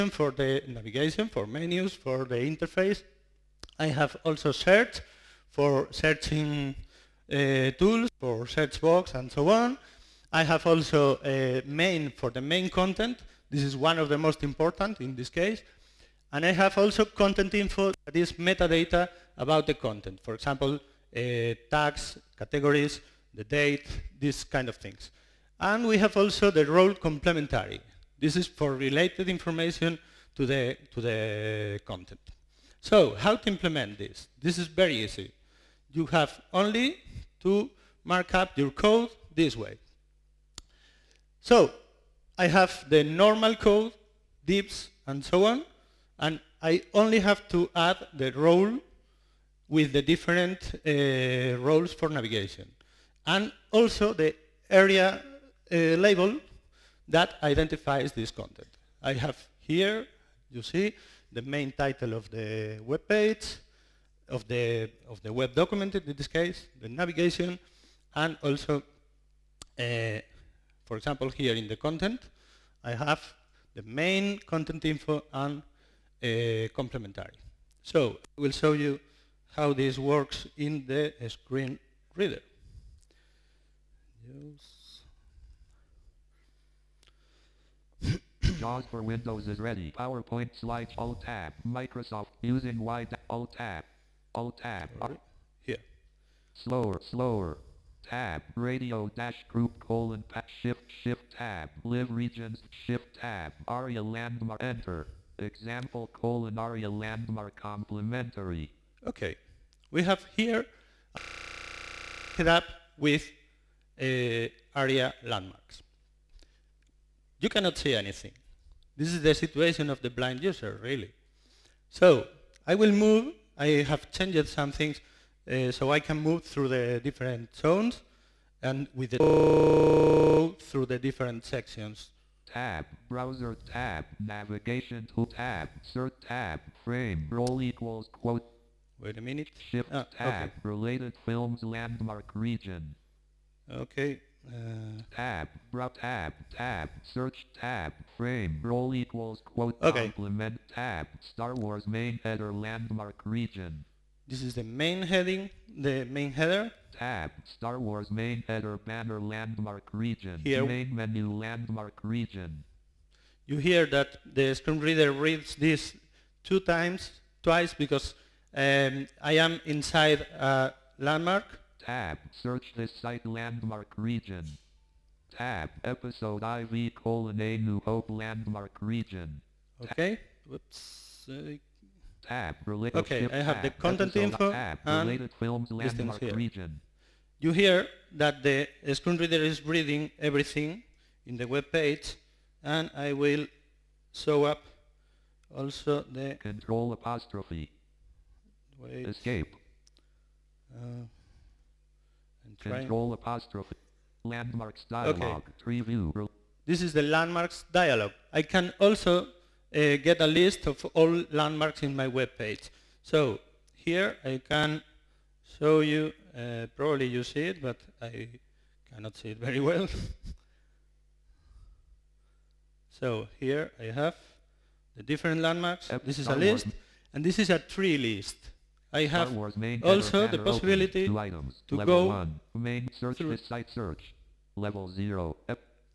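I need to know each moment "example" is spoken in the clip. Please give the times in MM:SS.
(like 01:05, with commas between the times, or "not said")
00:20, 01:10, 01:45.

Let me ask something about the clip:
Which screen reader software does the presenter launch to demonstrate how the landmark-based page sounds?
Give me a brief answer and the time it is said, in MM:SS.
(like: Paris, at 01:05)
JAWS, at 01:28.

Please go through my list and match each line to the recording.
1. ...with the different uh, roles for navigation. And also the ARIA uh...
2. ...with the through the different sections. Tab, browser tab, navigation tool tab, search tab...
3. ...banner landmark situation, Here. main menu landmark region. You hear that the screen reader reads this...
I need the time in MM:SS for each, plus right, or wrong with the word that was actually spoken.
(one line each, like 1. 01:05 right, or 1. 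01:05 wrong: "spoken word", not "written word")
1. 00:49 right
2. 02:08 right
3. 02:38 wrong: "region", not "situation".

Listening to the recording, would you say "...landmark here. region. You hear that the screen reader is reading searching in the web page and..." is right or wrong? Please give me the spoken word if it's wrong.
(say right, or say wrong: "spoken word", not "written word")
wrong: "everything", not "searching".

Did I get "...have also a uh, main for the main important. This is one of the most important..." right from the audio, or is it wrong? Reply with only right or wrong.
wrong.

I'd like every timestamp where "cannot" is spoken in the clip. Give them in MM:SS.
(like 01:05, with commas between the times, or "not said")
01:57, 03:38.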